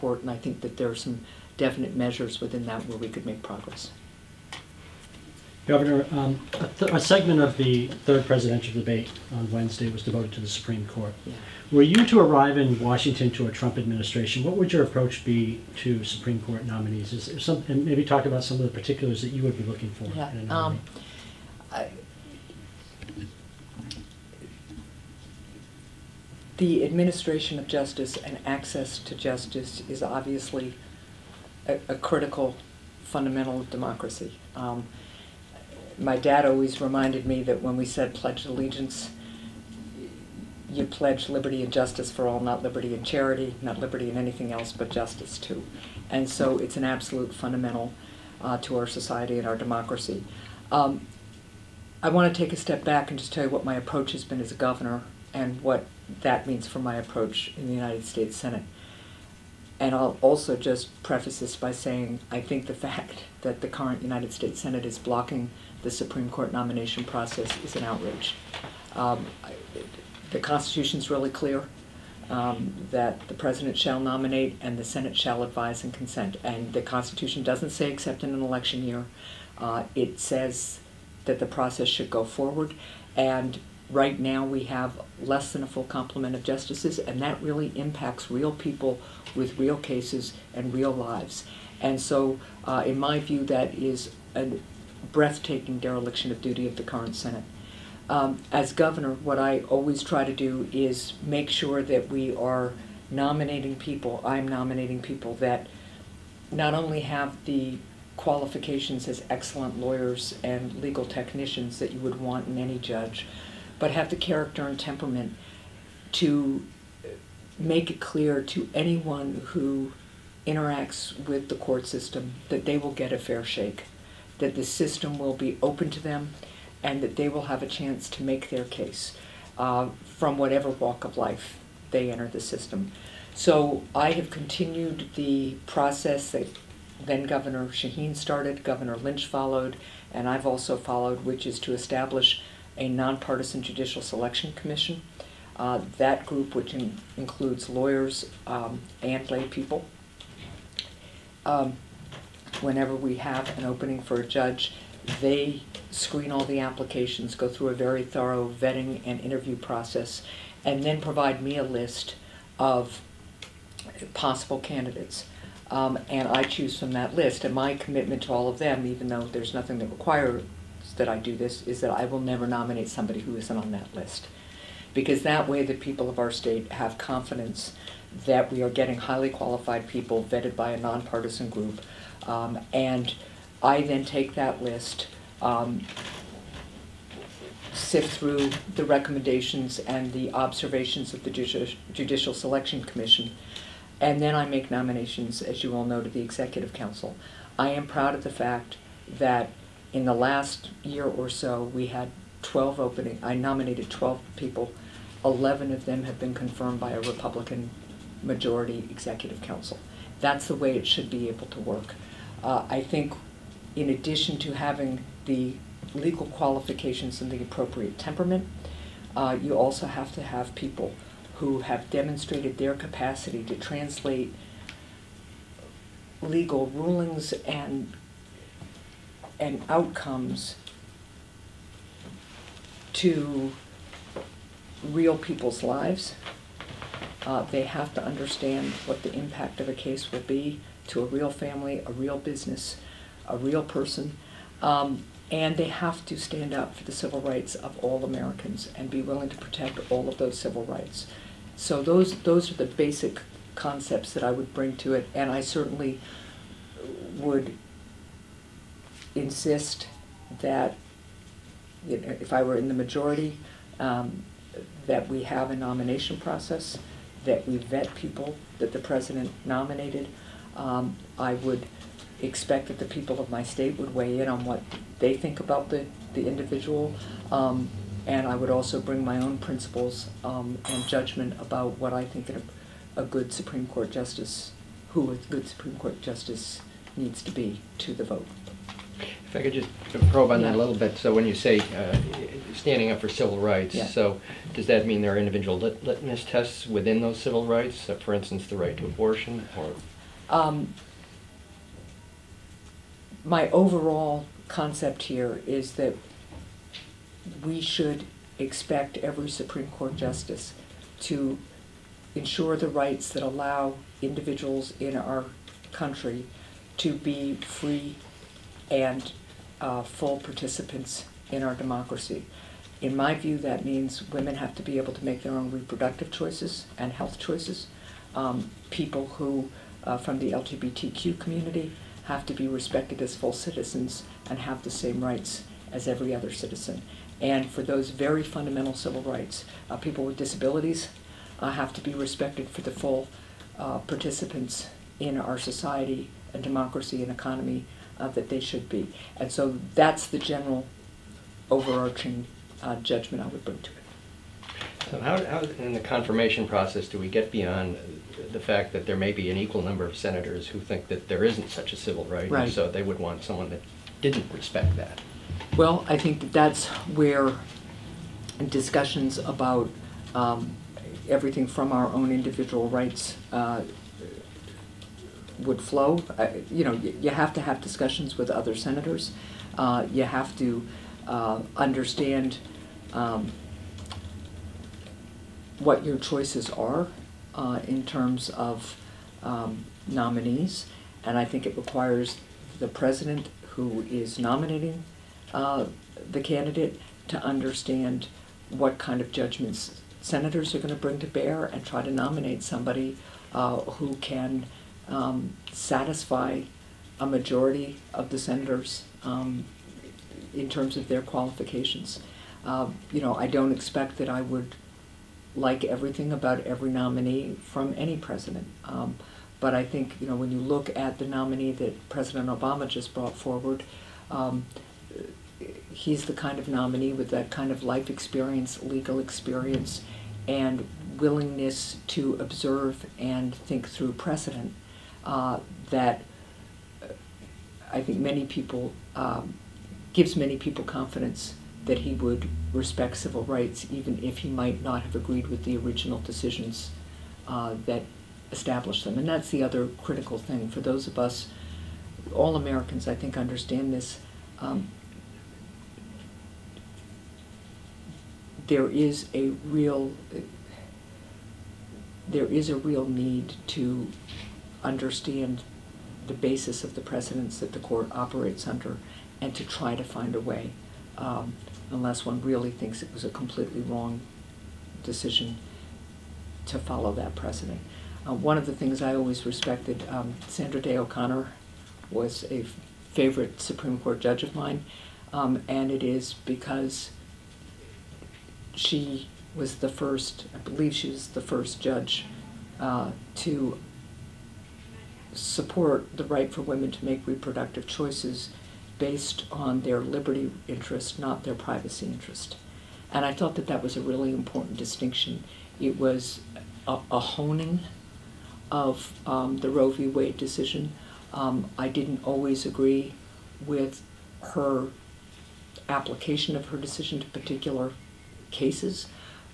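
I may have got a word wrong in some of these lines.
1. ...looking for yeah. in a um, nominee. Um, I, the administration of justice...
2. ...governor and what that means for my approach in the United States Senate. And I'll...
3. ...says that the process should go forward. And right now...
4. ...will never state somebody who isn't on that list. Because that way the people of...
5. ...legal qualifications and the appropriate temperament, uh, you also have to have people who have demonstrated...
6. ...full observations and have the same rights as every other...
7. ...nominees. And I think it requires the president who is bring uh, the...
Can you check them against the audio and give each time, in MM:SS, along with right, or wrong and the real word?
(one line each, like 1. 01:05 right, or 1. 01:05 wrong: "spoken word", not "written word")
1. 00:19 right
2. 00:54 right
3. 01:20 right
4. 02:52 wrong: "nominate", not "state"
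5. 03:35 right
6. 05:33 wrong: "citizens", not "observations"
7. 06:29 wrong: "nominating", not "bring".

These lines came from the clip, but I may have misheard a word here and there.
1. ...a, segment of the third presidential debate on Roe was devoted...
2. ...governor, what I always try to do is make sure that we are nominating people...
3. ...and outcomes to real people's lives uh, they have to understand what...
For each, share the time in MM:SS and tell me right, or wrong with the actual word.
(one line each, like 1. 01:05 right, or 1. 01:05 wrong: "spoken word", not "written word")
1. 00:06 wrong: "Wednesday", not "Roe"
2. 01:38 right
3. 03:49 right.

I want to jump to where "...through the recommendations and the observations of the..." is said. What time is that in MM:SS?
03:08.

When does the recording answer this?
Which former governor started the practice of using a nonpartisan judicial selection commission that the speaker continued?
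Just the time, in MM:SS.
02:17.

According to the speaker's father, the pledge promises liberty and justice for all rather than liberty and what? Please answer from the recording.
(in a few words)
charity.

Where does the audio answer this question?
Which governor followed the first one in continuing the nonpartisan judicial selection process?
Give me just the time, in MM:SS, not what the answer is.
02:18.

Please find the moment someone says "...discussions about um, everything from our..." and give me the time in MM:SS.
06:08.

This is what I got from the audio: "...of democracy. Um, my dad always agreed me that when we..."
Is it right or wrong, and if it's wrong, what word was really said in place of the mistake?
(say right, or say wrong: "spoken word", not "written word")
wrong: "reminded", not "agreed".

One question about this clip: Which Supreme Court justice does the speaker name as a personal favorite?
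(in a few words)
Sandra Day O'Connor.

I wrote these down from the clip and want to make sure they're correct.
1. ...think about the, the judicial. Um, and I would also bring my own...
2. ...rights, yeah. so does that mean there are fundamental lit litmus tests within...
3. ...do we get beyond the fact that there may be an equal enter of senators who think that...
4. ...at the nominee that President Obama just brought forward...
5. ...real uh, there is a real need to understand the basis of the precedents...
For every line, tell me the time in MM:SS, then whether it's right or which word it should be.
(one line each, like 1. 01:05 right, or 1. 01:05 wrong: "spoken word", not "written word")
1. 04:35 wrong: "individual", not "judicial"
2. 04:53 wrong: "individual", not "fundamental"
3. 05:56 wrong: "number", not "enter"
4. 07:00 right
5. 07:39 right.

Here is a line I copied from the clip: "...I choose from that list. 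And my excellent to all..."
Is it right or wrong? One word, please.
wrong.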